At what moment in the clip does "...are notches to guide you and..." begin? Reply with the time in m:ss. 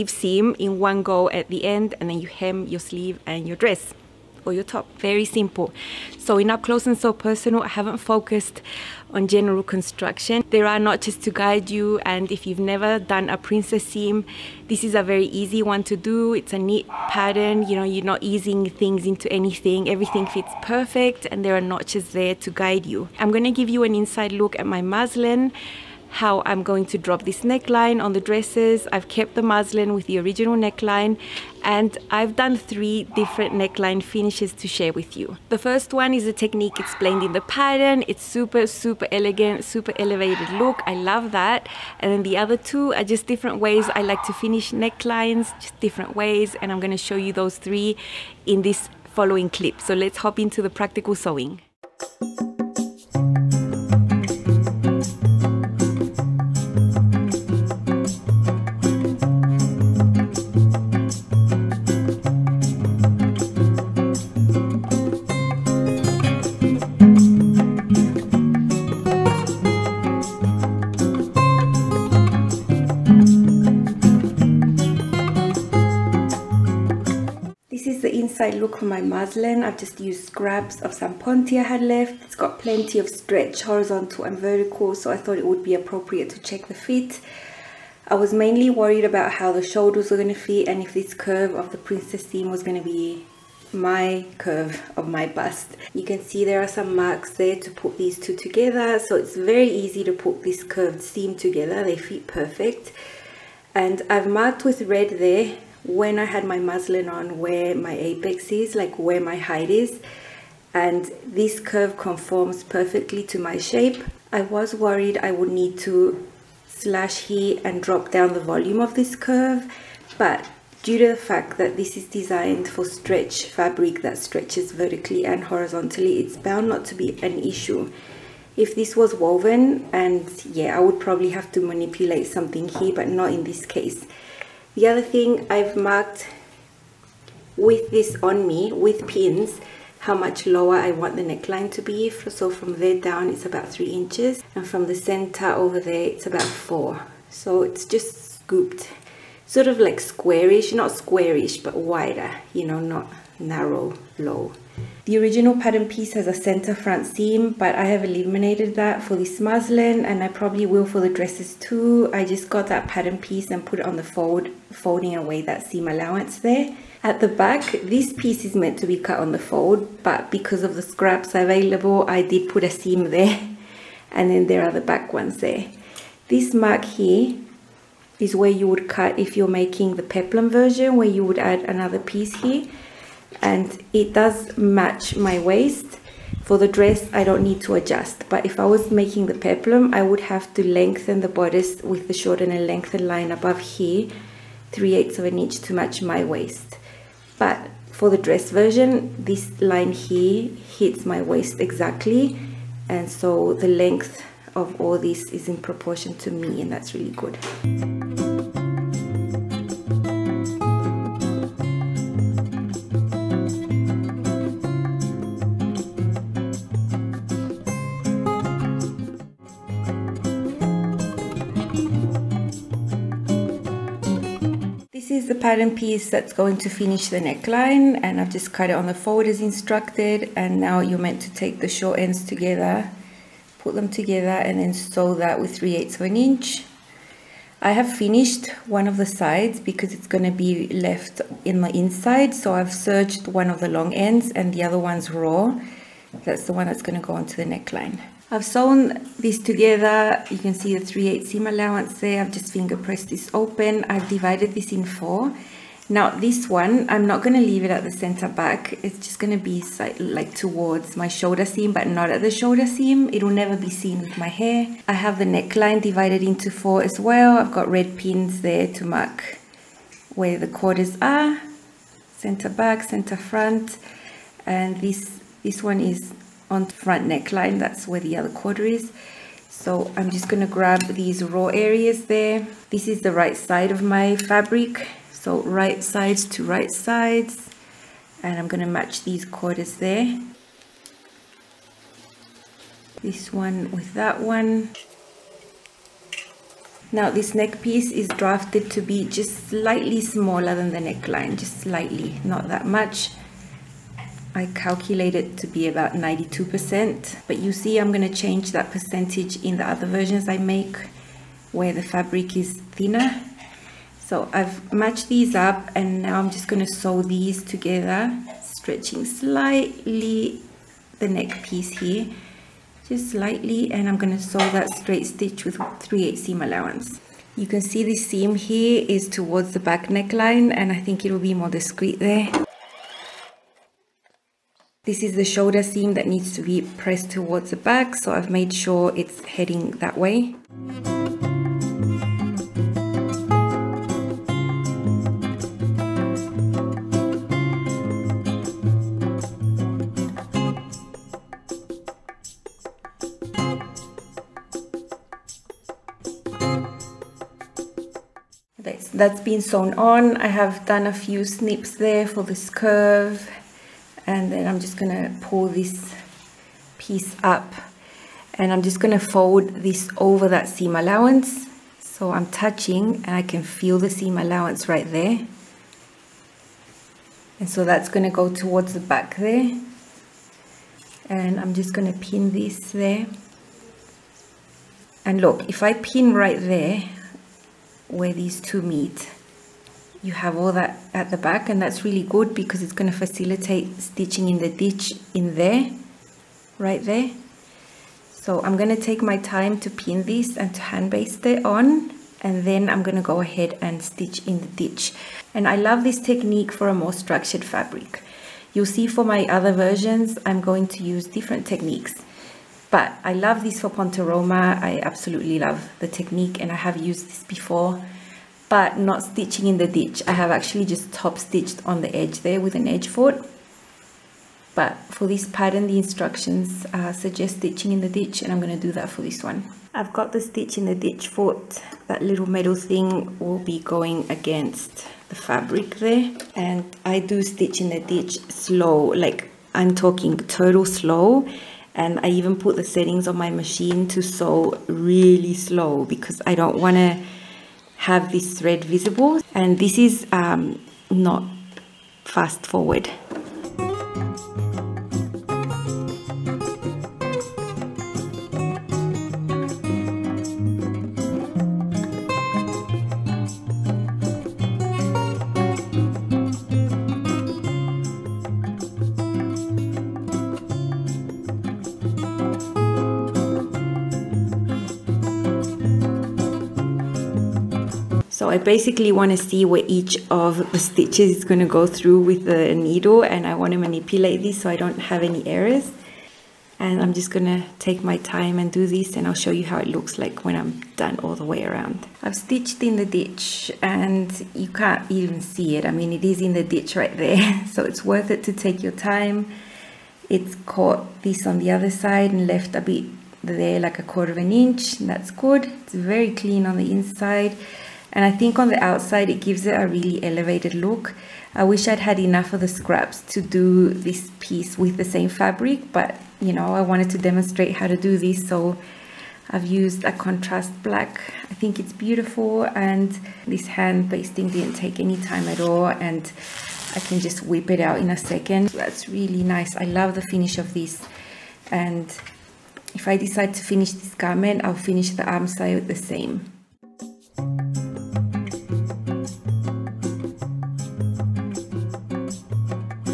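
0:10.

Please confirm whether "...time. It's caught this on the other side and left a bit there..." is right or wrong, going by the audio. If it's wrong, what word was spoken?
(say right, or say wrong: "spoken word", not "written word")
right.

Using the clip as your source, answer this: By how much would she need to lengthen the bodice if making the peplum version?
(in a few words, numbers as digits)
3/8 inch.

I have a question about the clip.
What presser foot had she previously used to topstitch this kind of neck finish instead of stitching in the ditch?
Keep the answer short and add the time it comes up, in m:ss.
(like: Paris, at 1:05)
edge foot, at 7:02.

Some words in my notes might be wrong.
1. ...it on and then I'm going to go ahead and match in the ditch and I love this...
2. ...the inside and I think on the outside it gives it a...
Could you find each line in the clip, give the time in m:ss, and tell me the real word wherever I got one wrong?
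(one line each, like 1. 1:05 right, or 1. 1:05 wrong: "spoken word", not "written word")
1. 6:41 wrong: "stitch", not "match"
2. 8:26 right.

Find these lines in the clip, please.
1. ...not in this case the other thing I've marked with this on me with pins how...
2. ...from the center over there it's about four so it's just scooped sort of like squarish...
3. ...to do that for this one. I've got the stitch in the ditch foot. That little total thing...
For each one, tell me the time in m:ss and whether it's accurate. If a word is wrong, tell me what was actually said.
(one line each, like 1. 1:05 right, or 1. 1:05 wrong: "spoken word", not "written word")
1. 2:13 right
2. 2:24 right
3. 7:08 wrong: "metal", not "total".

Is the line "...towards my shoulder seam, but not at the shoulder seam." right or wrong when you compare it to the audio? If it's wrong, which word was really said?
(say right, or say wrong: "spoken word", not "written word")
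right.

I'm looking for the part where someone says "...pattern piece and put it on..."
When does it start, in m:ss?
2:42.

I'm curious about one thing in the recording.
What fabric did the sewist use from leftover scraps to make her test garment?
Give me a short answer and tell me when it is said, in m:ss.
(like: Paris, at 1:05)
Ponte, at 1:21.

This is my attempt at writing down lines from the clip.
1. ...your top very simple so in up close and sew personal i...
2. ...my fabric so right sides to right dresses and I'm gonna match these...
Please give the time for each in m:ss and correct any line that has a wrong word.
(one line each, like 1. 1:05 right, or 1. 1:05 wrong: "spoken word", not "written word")
1. 0:04 right
2. 4:43 wrong: "sides", not "dresses".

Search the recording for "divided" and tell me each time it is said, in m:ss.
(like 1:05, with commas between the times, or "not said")
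4:14, 4:25.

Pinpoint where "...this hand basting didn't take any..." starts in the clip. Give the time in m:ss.
8:43.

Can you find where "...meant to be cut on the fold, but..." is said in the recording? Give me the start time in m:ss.
2:48.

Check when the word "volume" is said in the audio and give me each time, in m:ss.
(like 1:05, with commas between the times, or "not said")
1:58.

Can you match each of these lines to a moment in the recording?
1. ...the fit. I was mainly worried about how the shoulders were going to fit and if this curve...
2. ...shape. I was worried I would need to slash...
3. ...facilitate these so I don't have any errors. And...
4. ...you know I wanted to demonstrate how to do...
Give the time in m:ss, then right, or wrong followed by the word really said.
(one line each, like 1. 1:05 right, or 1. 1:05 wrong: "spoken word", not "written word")
1. 1:26 right
2. 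1:53 right
3. 8:03 wrong: "manipulate", not "facilitate"
4. 8:36 right.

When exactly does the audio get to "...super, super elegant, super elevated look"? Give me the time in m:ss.
0:38.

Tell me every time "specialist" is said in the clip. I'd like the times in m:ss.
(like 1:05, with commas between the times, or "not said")
not said.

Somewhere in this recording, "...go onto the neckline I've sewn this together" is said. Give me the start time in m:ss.
4:07.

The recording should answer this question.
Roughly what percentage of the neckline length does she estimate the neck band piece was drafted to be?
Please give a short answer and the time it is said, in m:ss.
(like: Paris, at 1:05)
92%, at 5:05.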